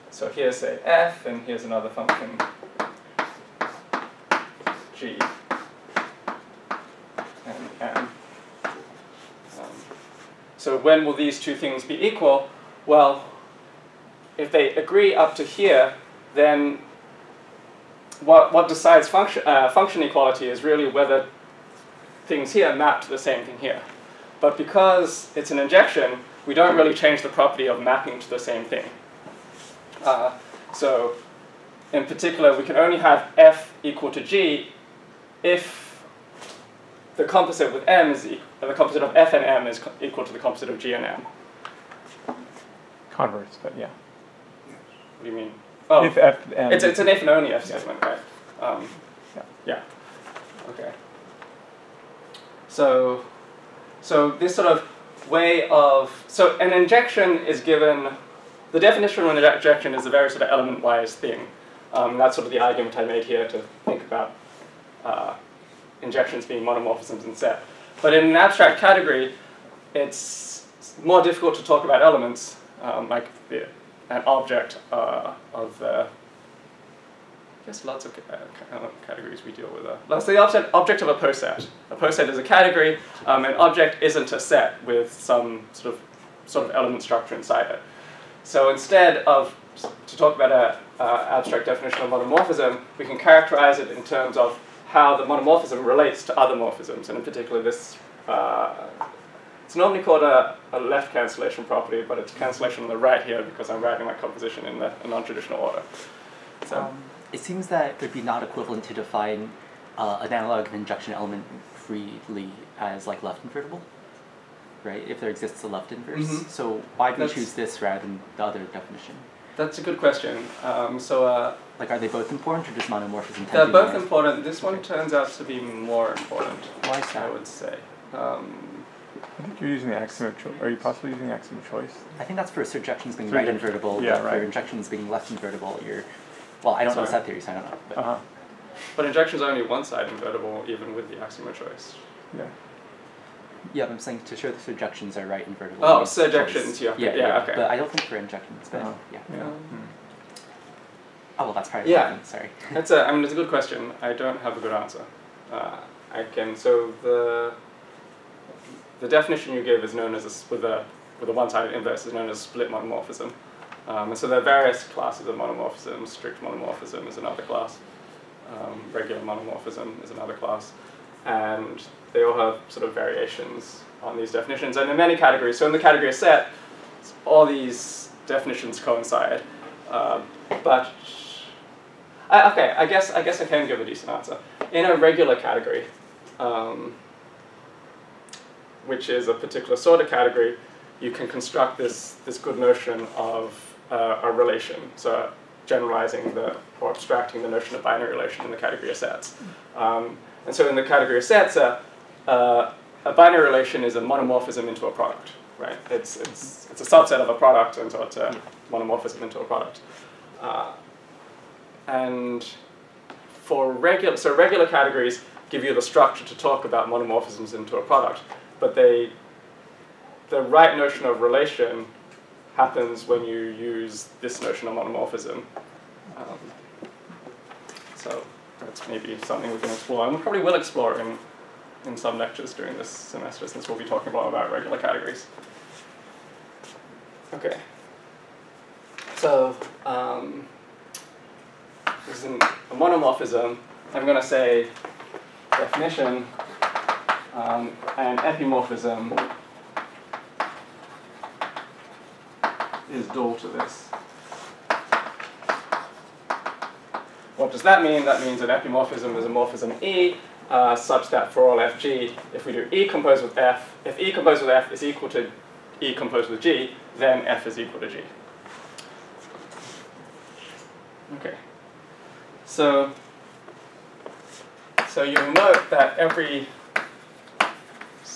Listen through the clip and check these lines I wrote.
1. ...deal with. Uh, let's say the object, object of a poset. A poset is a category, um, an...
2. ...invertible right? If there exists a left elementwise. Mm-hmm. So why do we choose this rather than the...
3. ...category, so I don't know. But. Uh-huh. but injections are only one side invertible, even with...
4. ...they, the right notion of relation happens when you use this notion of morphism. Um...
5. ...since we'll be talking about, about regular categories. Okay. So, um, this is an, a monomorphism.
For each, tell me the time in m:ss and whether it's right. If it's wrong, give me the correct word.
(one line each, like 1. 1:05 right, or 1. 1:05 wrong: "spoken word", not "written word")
1. 1:19 right
2. 1:53 wrong: "inverse", not "elementwise"
3. 2:17 wrong: "theory", not "category"
4. 3:38 wrong: "monomorphism", not "morphism"
5. 3:53 right.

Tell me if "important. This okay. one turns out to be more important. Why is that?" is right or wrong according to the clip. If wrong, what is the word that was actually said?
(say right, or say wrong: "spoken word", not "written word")
right.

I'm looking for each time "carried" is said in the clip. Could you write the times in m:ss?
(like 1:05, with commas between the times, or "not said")
not said.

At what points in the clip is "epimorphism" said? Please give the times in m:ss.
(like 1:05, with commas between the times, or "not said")
4:08, 4:18.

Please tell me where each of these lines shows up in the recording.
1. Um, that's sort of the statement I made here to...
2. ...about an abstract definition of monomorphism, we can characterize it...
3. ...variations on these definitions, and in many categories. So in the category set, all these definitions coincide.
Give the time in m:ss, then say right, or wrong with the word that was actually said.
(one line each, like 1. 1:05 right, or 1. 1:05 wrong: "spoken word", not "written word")
1. 1:01 wrong: "argument", not "statement"
2. 1:30 right
3. 2:52 right.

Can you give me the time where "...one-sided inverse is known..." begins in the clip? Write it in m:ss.
2:41.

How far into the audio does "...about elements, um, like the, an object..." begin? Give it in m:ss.
1:11.